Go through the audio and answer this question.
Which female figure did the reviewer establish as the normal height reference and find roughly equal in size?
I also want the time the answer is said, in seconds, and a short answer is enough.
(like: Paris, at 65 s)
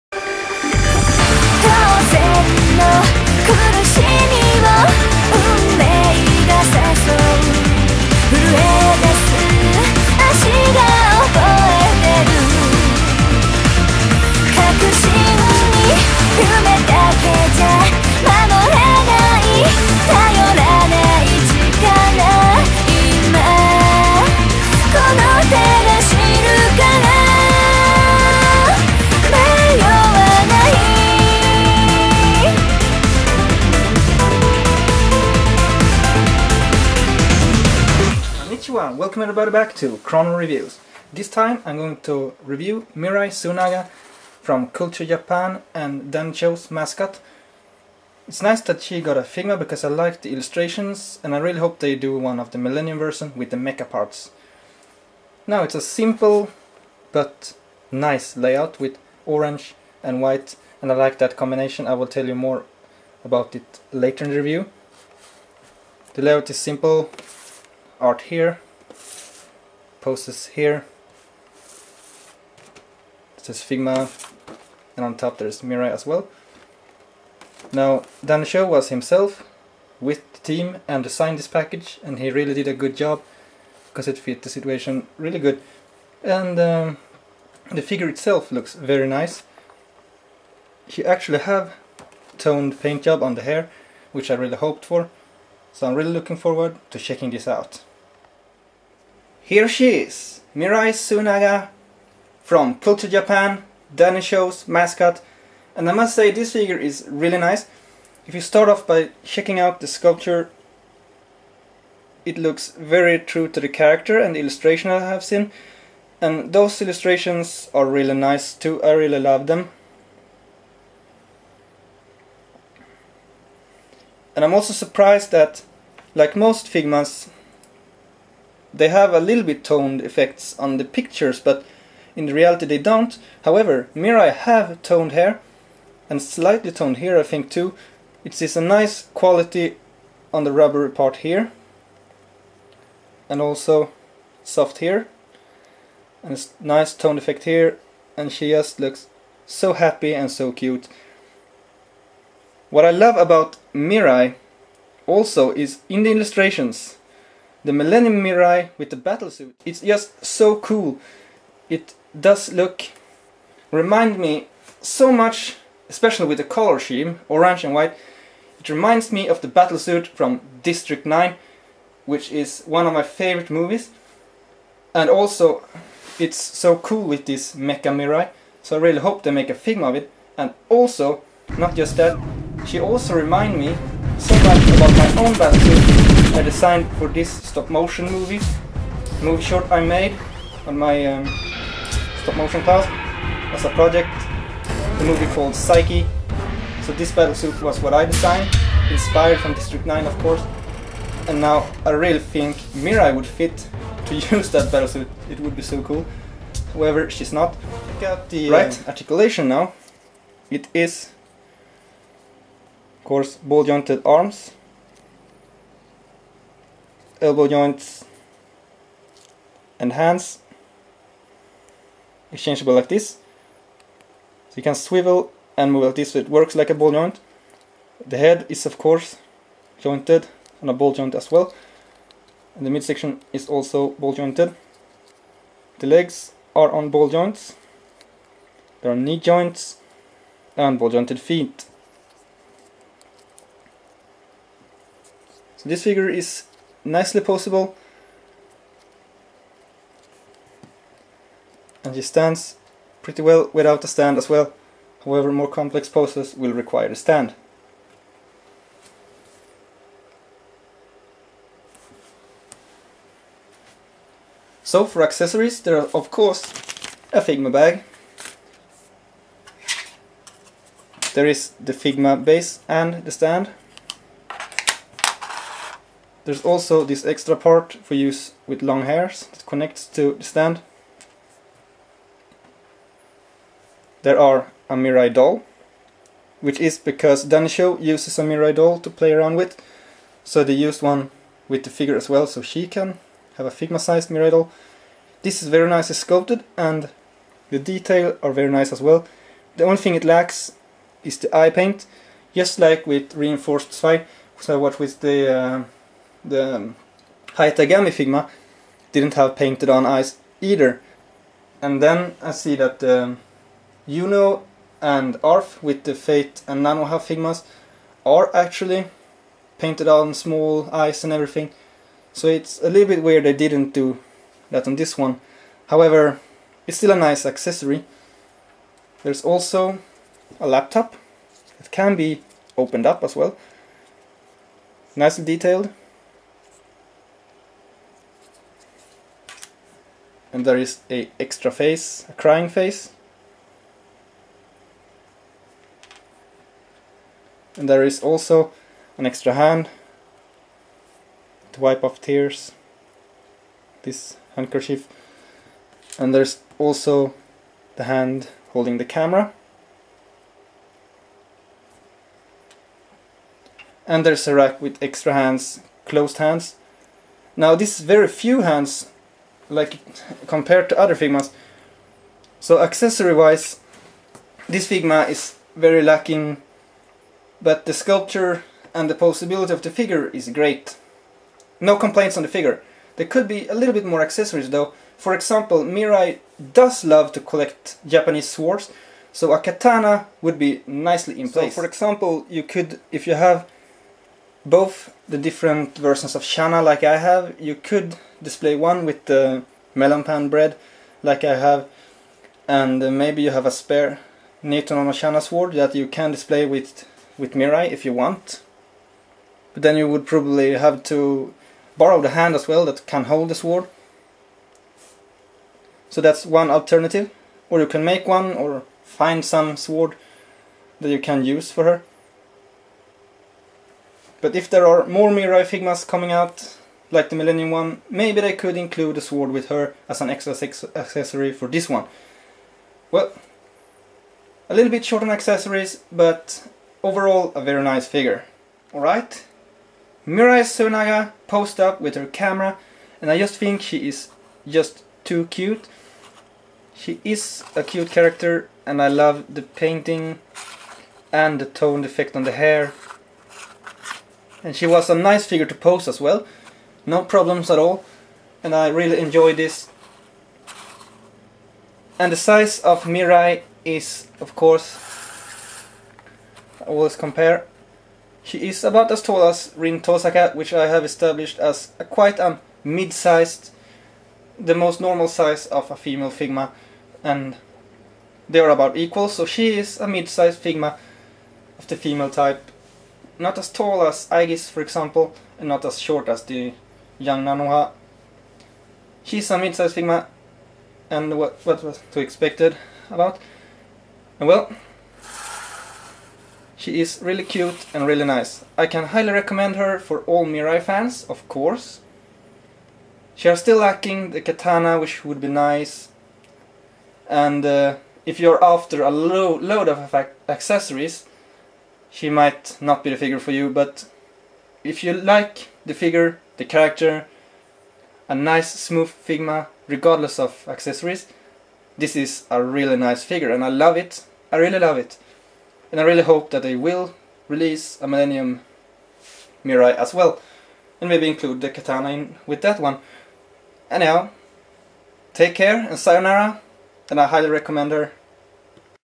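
Rin Tosaka, at 469 s.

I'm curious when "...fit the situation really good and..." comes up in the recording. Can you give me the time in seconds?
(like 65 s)
84 s.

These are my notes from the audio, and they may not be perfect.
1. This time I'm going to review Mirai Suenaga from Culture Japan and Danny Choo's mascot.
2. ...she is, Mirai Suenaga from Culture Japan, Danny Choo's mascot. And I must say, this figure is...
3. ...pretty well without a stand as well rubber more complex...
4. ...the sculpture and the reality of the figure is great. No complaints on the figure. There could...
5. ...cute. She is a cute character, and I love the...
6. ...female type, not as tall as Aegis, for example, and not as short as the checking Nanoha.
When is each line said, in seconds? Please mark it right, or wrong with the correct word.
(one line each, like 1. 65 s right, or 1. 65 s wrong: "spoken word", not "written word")
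1. 41 s right
2. 99 s right
3. 253 s wrong: "however", not "rubber"
4. 377 s wrong: "possibility", not "reality"
5. 445 s right
6. 481 s wrong: "young", not "checking".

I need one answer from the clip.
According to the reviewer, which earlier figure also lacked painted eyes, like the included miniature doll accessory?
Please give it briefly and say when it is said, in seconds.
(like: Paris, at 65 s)
Reinforce Zwei, at 303 s.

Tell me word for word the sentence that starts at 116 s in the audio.
And those illustrations are really nice too, I really love them.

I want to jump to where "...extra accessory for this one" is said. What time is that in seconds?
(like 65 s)
430 s.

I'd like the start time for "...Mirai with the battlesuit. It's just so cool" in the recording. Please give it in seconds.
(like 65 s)
158 s.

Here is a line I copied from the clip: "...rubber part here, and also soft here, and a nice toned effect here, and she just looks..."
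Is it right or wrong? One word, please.
right.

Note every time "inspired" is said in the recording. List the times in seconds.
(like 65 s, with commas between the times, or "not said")
198 s.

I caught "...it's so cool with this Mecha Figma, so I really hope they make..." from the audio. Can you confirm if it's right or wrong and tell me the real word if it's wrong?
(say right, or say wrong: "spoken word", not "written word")
wrong: "Mirai", not "Figma".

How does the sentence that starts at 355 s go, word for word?
And there's also the hand holding the camera.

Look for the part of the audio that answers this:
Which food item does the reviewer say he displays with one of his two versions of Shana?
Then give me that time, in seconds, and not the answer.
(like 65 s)
399 s.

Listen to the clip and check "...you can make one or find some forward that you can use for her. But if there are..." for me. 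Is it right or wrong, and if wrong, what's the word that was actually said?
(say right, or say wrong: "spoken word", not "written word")
wrong: "sword", not "forward".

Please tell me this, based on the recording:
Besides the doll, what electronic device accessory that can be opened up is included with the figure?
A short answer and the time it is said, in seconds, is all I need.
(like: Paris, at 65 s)
A laptop, at 330 s.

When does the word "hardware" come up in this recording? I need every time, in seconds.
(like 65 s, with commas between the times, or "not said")
not said.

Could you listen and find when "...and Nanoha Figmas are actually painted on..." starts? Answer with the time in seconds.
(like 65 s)
316 s.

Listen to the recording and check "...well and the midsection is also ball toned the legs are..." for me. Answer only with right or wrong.
wrong.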